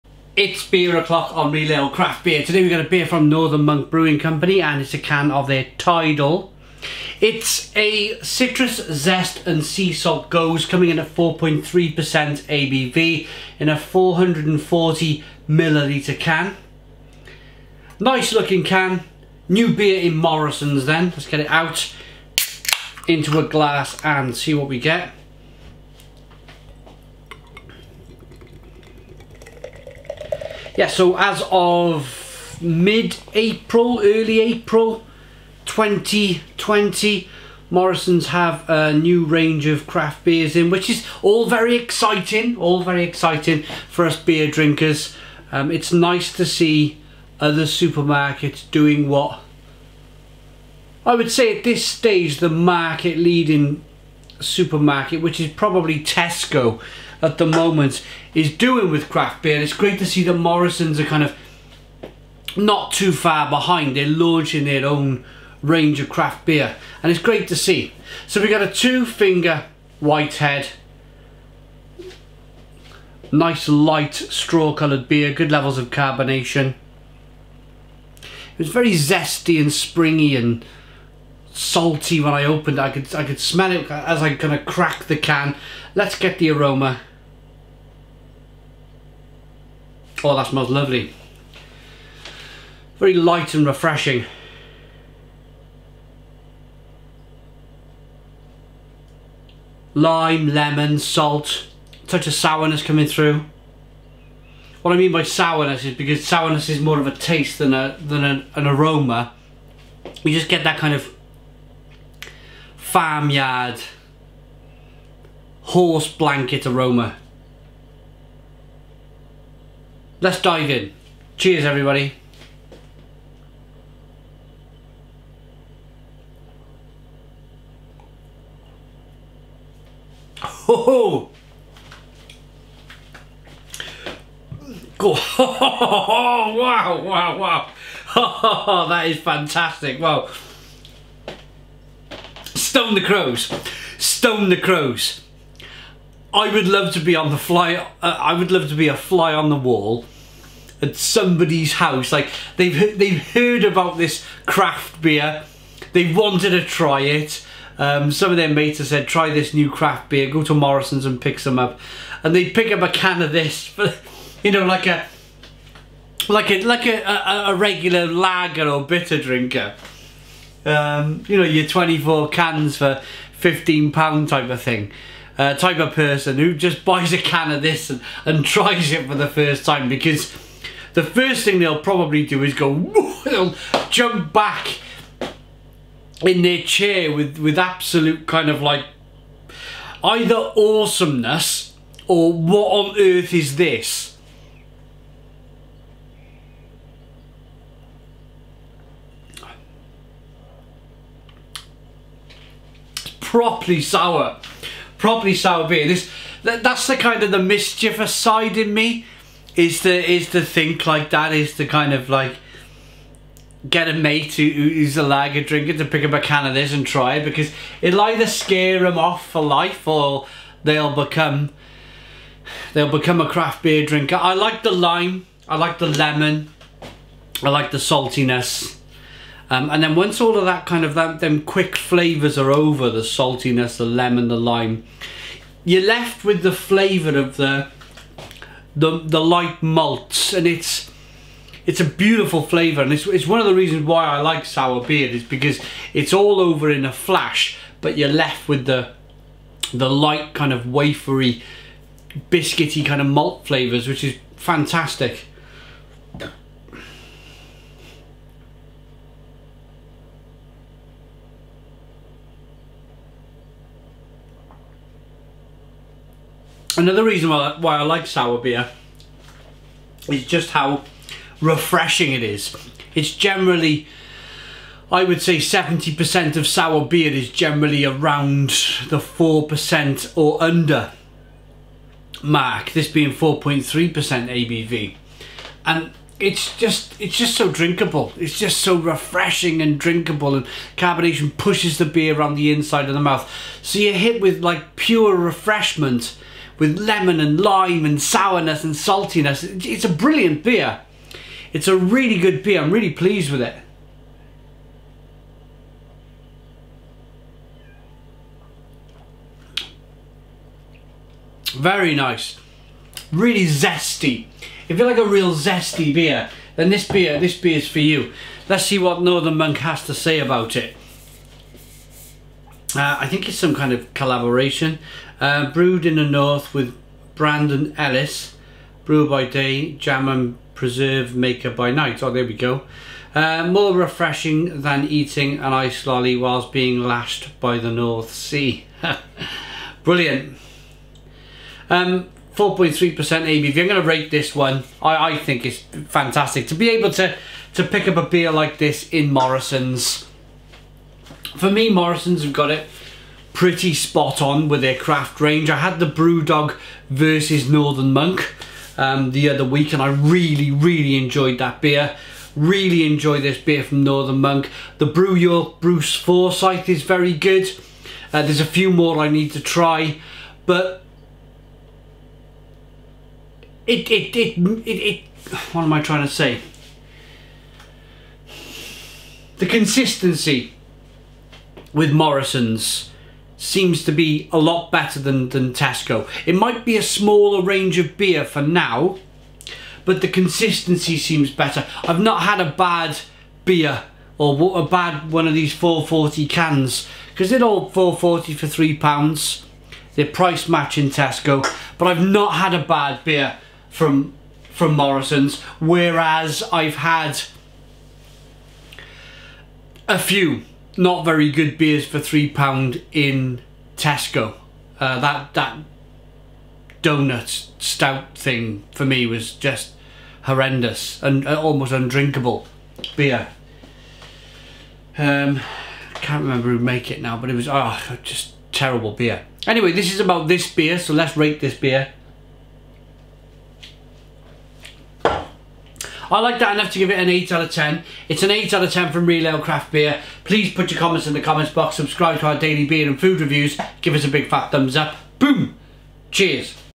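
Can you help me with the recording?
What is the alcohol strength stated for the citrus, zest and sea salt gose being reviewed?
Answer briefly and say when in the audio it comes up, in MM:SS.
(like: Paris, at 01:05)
4.3%, at 00:11.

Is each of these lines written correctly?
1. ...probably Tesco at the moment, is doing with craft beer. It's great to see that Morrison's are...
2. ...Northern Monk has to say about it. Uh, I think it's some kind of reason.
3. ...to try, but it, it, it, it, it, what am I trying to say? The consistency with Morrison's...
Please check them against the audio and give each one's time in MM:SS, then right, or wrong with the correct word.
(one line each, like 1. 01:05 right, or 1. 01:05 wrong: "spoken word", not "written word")
1. 00:55 right
2. 05:19 wrong: "collaboration", not "reason"
3. 06:09 right.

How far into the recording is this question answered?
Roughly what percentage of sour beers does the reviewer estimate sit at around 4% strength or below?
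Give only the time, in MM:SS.
04:35.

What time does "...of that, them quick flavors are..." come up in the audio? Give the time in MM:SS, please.
03:50.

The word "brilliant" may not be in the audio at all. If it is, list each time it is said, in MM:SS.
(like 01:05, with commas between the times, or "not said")
04:59, 05:39.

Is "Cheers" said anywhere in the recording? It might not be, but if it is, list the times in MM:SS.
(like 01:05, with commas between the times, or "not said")
02:01, 07:26.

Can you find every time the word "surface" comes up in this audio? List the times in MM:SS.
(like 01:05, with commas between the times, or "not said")
not said.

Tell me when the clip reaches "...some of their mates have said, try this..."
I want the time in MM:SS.
02:38.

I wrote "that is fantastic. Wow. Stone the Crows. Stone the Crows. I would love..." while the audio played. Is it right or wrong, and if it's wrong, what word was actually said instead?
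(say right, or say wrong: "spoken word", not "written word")
right.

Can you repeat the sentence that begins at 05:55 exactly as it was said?
I had the Brewdog versus Northern Monk um, the other week and I really, really enjoyed that beer.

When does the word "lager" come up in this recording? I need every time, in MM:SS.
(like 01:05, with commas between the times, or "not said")
02:48, 03:35.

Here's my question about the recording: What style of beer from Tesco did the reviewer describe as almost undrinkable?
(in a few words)
donut stout.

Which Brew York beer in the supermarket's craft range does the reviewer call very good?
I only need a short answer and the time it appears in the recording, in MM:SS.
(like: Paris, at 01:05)
Bruce Forsyth, at 06:05.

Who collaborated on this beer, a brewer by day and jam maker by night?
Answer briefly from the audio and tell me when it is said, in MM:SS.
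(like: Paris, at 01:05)
Brandon Ellis, at 05:27.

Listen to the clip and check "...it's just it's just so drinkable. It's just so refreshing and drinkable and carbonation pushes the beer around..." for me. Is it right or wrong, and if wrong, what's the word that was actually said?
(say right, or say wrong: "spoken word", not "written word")
right.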